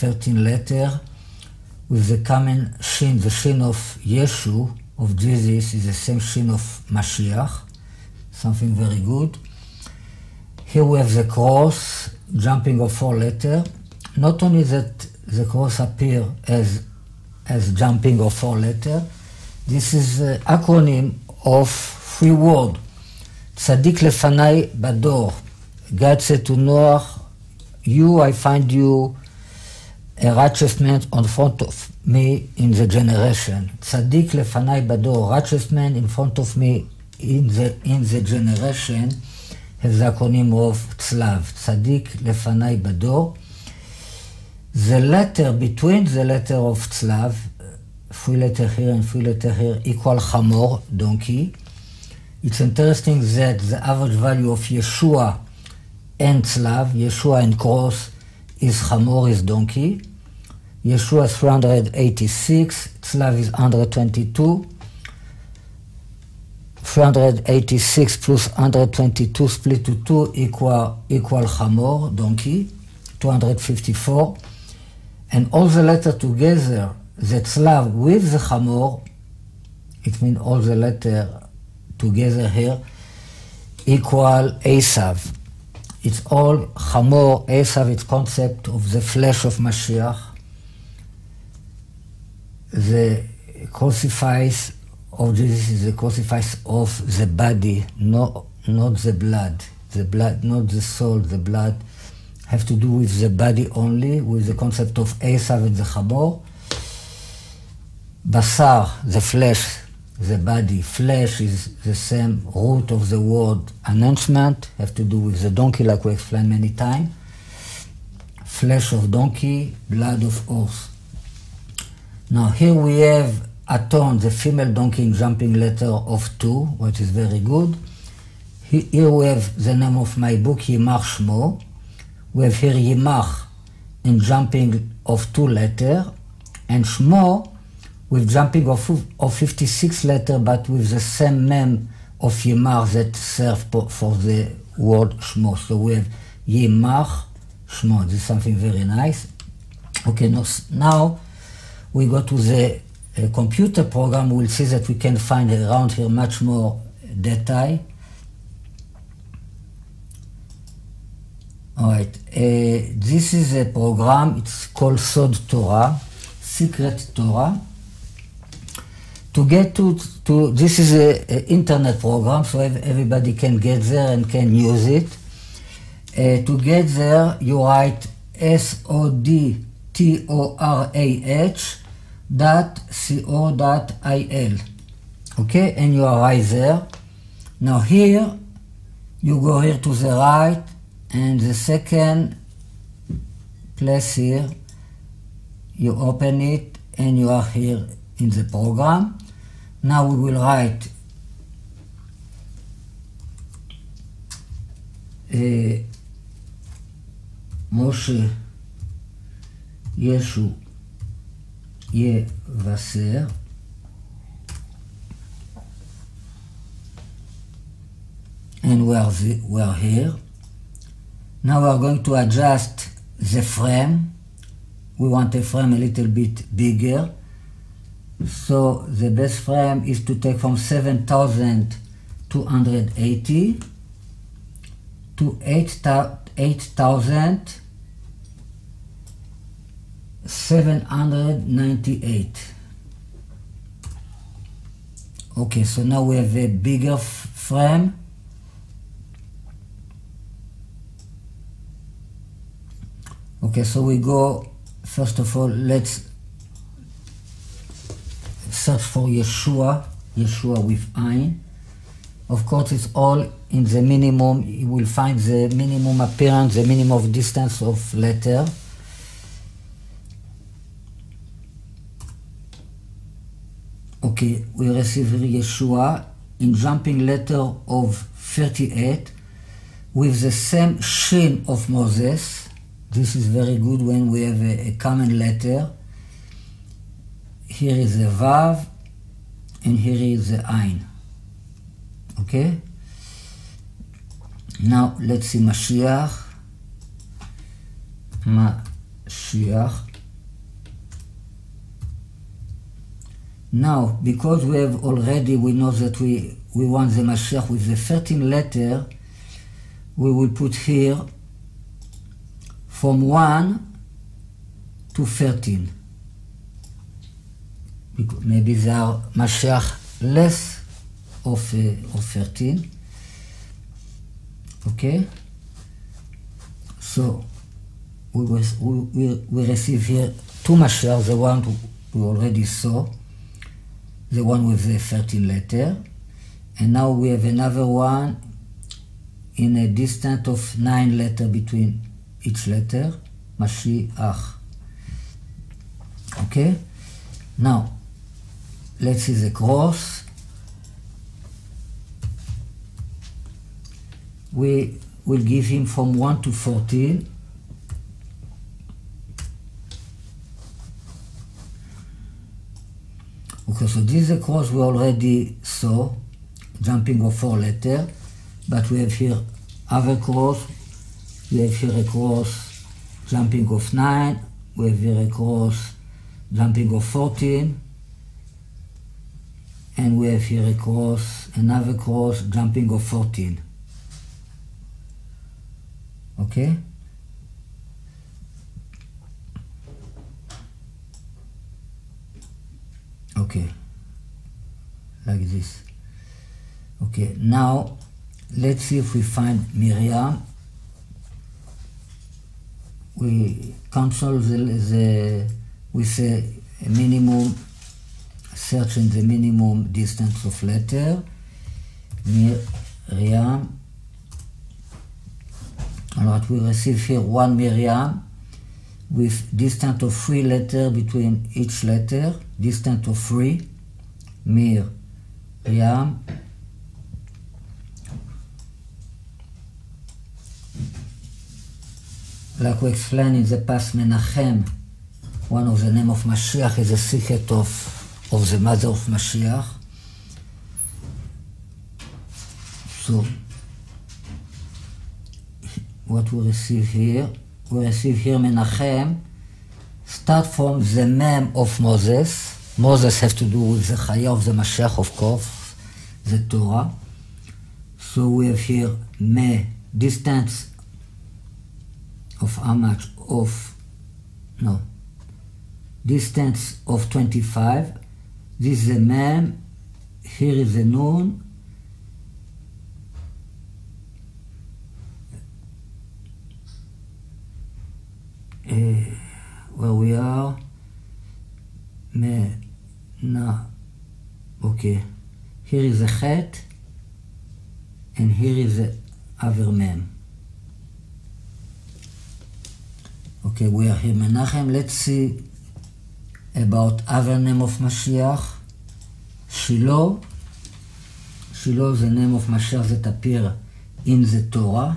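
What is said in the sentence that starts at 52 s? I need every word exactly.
It's interesting that the average value of Yeshua and Tzlav, Yeshua and cross, is Hamor, is donkey.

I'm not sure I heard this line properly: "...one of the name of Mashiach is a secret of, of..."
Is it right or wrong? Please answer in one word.
right.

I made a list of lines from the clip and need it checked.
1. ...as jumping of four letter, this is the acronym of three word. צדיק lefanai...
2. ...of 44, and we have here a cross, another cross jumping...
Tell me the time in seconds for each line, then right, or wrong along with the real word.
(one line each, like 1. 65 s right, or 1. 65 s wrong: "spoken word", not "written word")
1. 17 s right
2. 376 s wrong: "14", not "44".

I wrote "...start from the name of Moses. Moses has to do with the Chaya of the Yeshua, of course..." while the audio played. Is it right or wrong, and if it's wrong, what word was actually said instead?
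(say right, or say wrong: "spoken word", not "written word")
wrong: "Mashiach", not "Yeshua".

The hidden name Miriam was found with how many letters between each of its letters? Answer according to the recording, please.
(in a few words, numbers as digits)
3.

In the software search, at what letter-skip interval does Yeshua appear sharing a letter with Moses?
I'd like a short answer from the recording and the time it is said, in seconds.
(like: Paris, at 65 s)
38, at 276 s.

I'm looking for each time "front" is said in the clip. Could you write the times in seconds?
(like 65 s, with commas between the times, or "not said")
31 s, 36 s.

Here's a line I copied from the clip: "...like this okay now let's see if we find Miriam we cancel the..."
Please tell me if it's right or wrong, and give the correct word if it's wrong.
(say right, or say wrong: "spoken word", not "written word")
right.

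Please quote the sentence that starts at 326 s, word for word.
So, we, was, we, we receive here two Mashiach, the one we already saw the one with the 13 letter.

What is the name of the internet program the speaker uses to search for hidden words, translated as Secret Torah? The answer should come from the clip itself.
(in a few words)
Sod Torah.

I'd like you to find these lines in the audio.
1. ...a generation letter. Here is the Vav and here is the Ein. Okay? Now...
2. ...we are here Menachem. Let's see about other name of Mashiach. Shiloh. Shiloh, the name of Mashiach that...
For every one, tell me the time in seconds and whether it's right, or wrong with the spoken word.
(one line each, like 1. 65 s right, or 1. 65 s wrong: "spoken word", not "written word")
1. 284 s wrong: "common", not "generation"
2. 493 s right.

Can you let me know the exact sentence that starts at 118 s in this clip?
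Flesh of donkey, blood of horse.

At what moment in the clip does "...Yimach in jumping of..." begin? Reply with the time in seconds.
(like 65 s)
132 s.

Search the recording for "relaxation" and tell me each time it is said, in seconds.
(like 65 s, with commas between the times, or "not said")
not said.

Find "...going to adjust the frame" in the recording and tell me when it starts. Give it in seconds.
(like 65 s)
221 s.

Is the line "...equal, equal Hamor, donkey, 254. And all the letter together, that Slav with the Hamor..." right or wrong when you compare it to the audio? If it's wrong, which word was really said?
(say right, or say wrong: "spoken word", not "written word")
right.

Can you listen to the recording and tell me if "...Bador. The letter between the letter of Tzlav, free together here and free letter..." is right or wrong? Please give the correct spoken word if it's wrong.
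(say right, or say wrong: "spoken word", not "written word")
wrong: "letter", not "together".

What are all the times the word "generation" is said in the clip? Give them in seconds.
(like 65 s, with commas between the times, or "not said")
32 s, 38 s.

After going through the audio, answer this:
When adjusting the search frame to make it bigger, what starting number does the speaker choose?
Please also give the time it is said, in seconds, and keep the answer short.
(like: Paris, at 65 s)
7,280, at 230 s.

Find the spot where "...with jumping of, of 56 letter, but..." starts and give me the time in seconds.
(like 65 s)
138 s.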